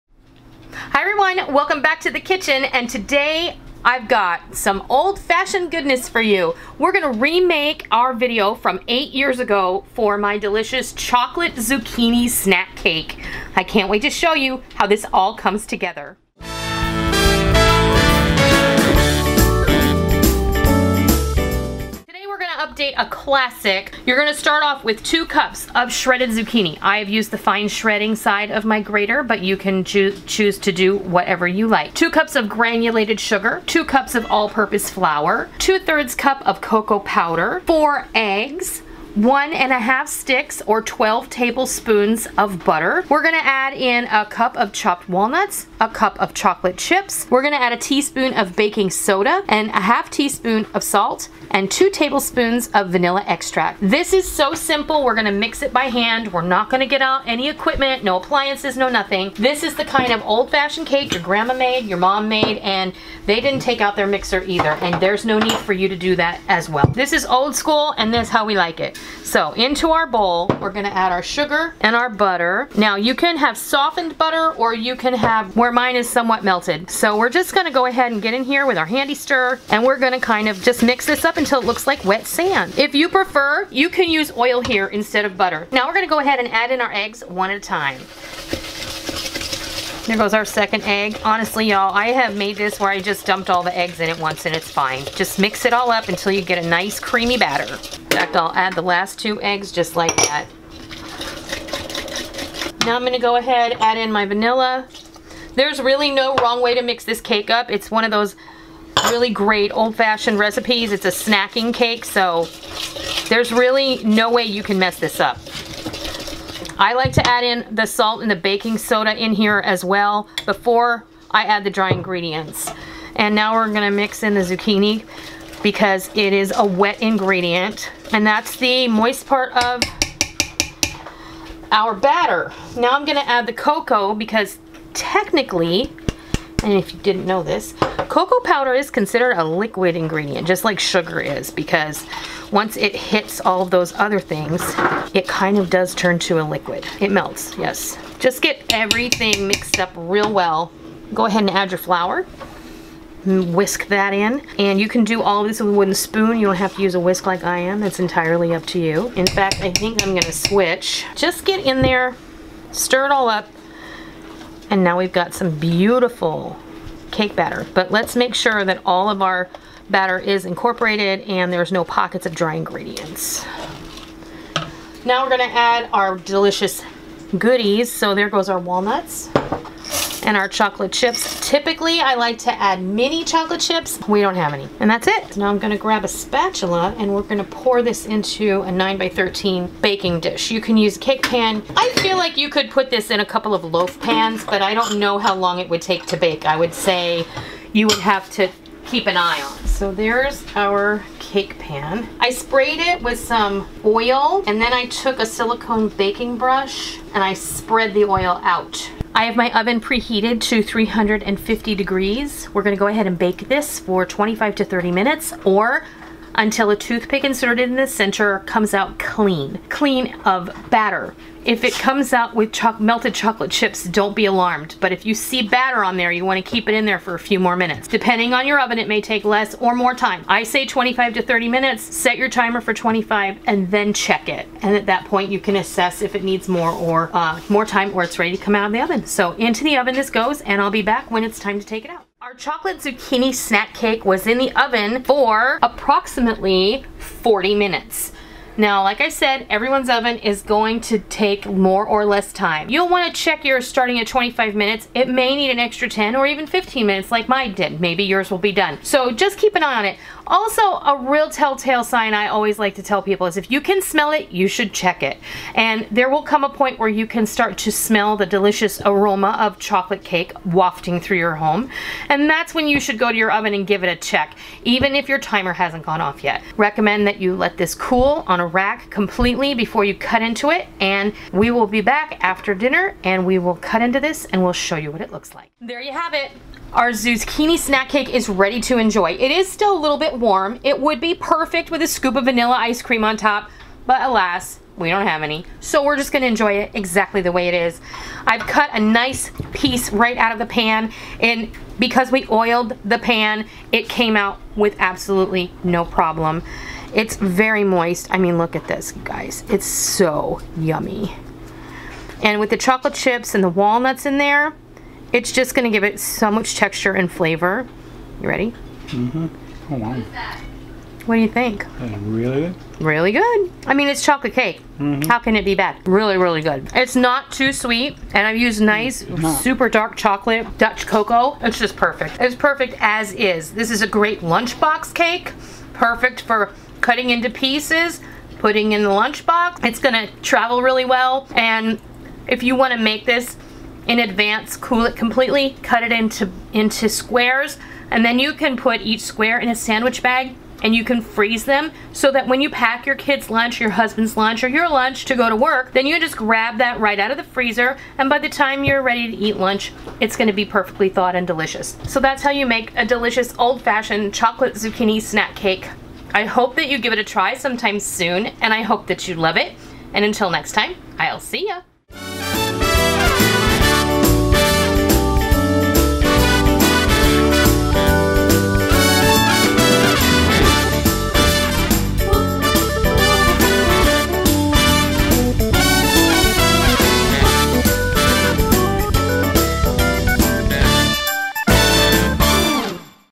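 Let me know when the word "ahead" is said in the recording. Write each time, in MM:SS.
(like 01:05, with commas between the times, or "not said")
01:17, 01:26, 01:43, 02:31, 03:32.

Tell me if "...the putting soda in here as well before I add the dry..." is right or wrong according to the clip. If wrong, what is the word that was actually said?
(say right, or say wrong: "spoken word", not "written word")
wrong: "baking", not "putting".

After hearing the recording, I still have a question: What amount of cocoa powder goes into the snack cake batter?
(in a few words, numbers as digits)
2/3 cup.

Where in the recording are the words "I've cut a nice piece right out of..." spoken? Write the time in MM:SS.
04:58.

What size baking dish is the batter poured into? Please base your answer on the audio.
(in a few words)
9 by 13.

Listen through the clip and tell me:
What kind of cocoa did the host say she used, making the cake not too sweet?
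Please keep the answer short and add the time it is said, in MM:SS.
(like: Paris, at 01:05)
Dutch cocoa, at 05:30.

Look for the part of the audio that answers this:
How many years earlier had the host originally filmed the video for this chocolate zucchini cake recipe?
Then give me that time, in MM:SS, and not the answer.
00:08.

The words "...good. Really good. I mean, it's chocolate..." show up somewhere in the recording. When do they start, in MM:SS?
05:22.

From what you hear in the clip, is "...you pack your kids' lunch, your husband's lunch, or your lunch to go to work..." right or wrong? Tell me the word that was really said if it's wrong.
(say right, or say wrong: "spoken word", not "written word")
right.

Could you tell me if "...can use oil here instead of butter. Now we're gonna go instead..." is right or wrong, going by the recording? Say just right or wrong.
wrong.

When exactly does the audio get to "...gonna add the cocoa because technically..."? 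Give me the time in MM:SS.
02:13.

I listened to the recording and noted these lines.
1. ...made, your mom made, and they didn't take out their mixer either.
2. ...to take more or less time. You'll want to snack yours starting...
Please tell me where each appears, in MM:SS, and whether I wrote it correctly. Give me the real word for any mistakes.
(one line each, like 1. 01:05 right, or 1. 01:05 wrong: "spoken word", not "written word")
1. 01:01 right
2. 04:10 wrong: "check", not "snack".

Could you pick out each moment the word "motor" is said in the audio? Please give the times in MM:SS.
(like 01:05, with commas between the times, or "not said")
not said.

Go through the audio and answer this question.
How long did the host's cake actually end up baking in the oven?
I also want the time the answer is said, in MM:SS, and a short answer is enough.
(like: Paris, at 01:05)
40 minutes, at 04:05.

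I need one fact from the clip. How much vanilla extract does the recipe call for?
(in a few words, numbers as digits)
2 tablespoons.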